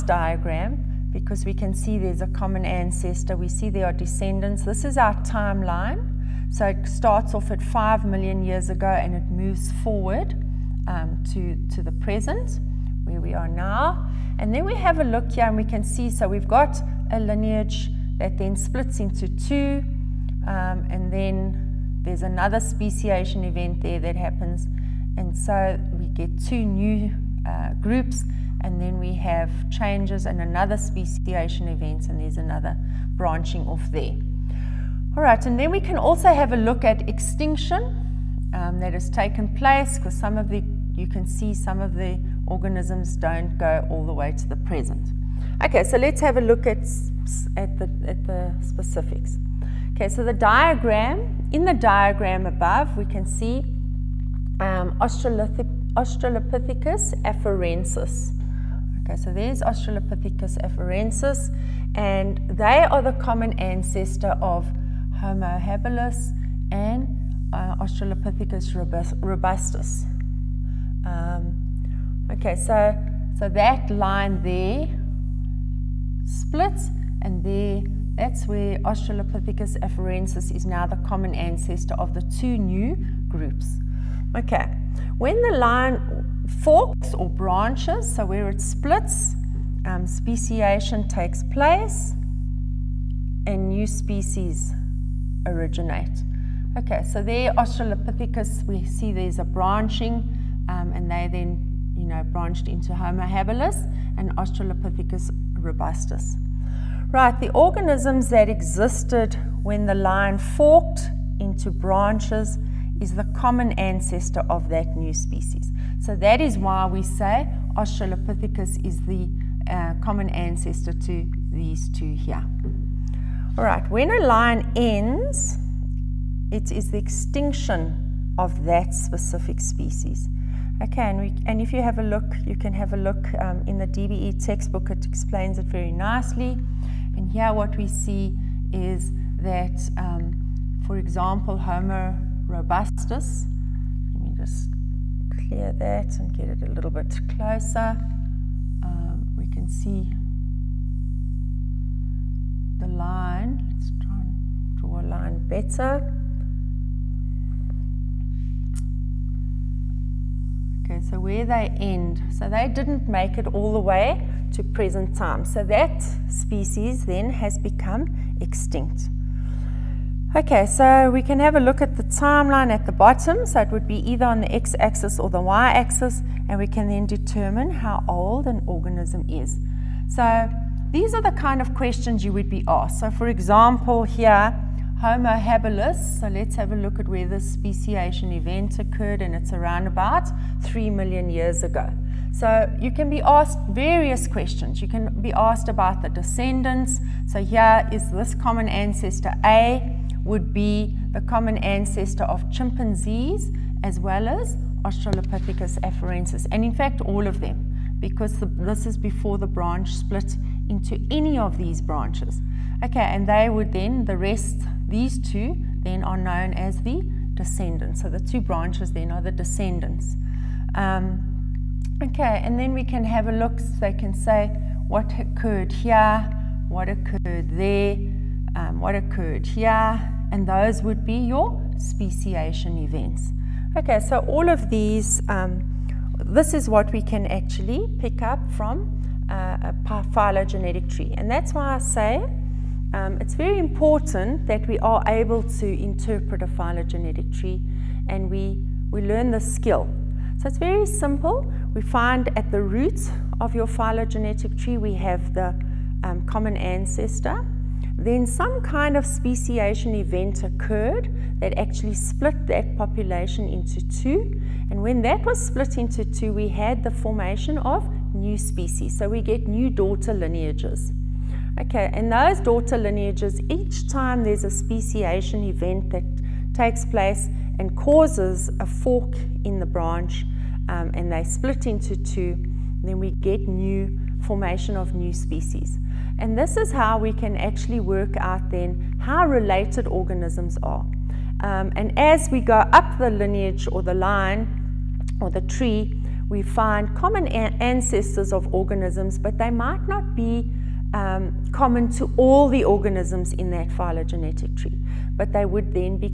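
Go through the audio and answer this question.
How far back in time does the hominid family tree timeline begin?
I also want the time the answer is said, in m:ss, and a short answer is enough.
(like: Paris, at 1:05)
5 million years ago, at 0:07.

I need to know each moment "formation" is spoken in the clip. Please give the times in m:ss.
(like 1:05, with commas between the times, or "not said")
4:26, 4:44.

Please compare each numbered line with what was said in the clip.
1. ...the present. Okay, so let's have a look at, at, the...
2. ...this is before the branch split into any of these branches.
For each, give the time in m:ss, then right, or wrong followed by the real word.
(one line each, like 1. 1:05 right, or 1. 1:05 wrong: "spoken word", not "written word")
1. 0:44 right
2. 3:28 right.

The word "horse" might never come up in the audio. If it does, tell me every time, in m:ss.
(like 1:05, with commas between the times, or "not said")
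not said.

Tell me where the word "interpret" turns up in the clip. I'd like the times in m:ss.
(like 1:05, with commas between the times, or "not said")
4:05.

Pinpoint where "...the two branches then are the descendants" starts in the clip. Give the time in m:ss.
3:38.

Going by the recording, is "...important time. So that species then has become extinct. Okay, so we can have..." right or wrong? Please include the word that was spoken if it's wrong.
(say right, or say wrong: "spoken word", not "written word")
wrong: "present", not "important".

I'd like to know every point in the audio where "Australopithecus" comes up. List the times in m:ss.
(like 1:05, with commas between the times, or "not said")
0:54, 0:59, 1:07, 1:18, 1:37, 1:44, 1:57, 3:24.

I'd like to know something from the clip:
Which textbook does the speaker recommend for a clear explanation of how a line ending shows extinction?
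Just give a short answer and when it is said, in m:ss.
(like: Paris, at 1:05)
DBE textbook, at 2:13.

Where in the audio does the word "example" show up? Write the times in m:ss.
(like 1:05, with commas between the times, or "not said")
2:20, 3:03.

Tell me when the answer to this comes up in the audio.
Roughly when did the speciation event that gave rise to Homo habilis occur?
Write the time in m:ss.
3:10.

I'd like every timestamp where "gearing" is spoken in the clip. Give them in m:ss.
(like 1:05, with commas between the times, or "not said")
not said.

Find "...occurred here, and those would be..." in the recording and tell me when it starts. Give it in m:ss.
3:48.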